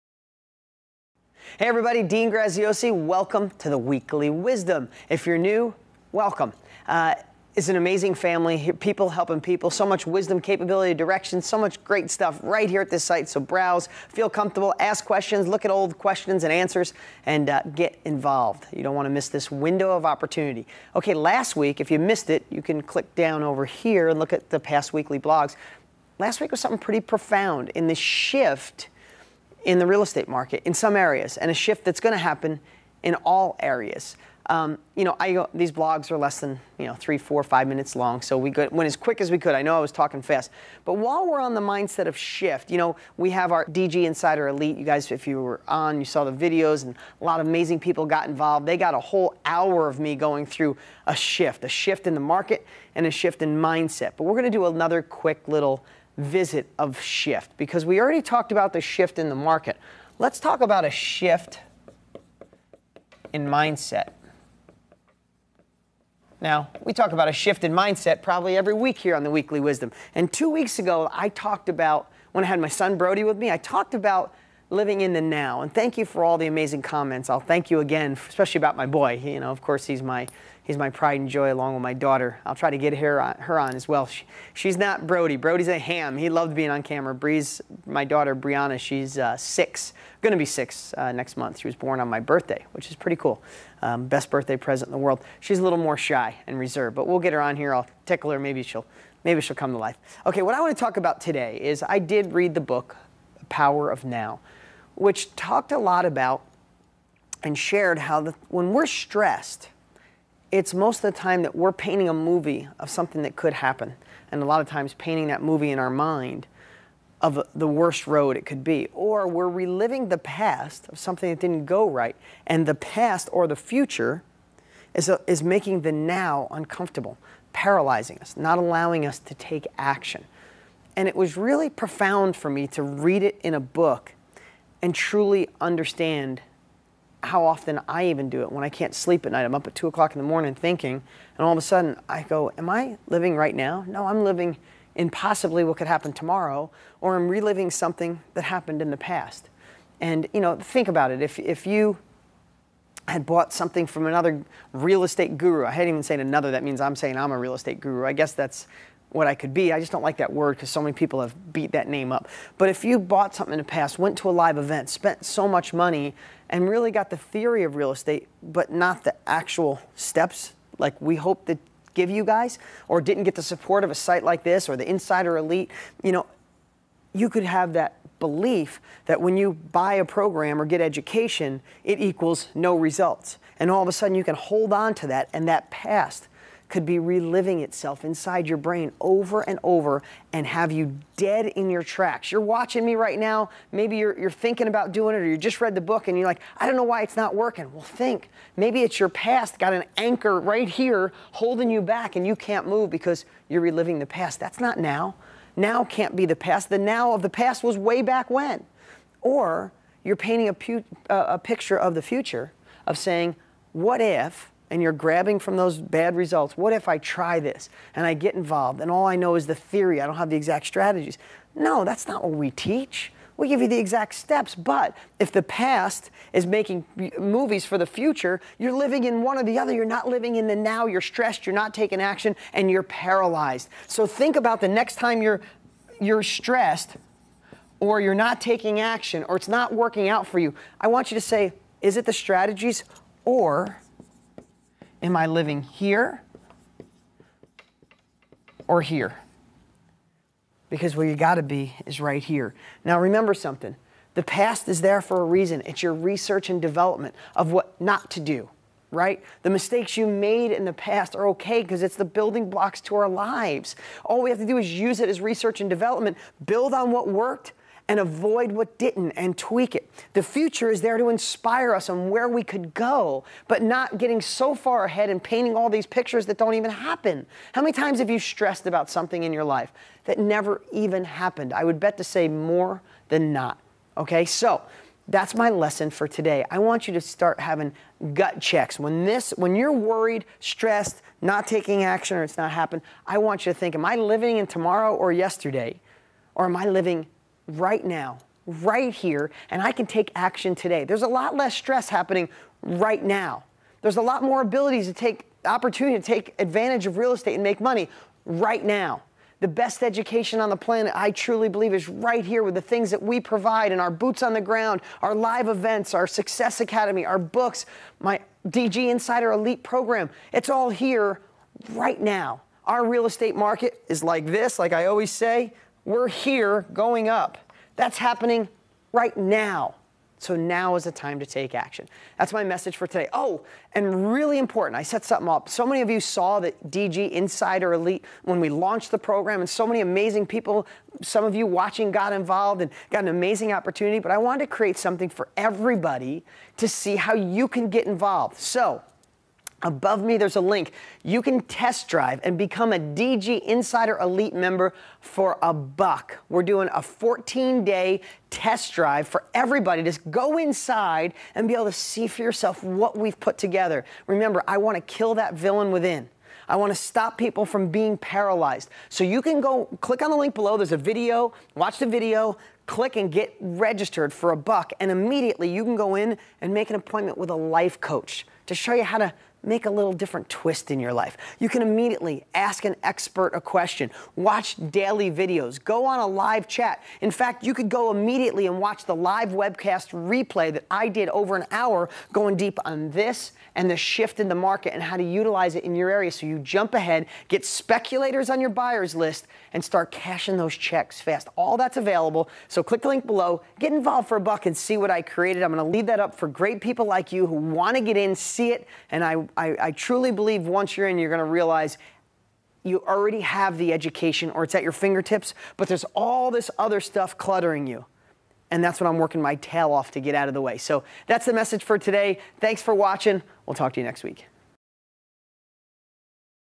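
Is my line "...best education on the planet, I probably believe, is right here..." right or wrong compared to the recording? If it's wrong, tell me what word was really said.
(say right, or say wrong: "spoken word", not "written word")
wrong: "truly", not "probably".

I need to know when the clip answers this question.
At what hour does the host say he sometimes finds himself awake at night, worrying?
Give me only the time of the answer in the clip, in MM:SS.
02:19.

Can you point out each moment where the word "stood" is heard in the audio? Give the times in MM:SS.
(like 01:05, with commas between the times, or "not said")
not said.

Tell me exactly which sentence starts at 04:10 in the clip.
Because where you got to be is right here.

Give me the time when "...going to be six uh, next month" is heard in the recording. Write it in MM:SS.
01:30.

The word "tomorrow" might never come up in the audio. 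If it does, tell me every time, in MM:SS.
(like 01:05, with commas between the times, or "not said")
02:26, 04:54.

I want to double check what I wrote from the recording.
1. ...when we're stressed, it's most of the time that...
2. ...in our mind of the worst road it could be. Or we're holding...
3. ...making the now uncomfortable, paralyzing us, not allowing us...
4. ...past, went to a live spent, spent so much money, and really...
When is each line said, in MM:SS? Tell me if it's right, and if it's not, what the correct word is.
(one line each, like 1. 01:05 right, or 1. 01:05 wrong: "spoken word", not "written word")
1. 01:48 right
2. 01:55 wrong: "reliving", not "holding"
3. 02:05 right
4. 02:43 wrong: "event", not "spent".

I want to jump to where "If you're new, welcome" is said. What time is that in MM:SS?
00:05.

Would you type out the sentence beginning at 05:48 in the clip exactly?
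So Above me, there's a link.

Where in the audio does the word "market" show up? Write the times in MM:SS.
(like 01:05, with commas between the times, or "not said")
00:30, 00:52, 00:59, 05:23, 06:34.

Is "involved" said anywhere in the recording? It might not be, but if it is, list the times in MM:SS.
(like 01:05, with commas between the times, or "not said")
00:18, 00:48, 03:38, 05:42, 05:47, 06:43.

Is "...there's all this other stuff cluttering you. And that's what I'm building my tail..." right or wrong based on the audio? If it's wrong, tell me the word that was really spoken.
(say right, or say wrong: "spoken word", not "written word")
wrong: "working", not "building".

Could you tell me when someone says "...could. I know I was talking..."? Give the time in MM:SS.
00:39.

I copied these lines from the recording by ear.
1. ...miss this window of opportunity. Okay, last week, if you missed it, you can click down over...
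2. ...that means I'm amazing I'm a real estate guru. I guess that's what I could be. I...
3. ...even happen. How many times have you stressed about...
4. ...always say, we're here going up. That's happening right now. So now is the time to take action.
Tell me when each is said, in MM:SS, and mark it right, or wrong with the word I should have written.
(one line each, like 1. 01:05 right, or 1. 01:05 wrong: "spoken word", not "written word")
1. 00:19 right
2. 02:36 wrong: "saying", not "amazing"
3. 04:36 right
4. 05:24 right.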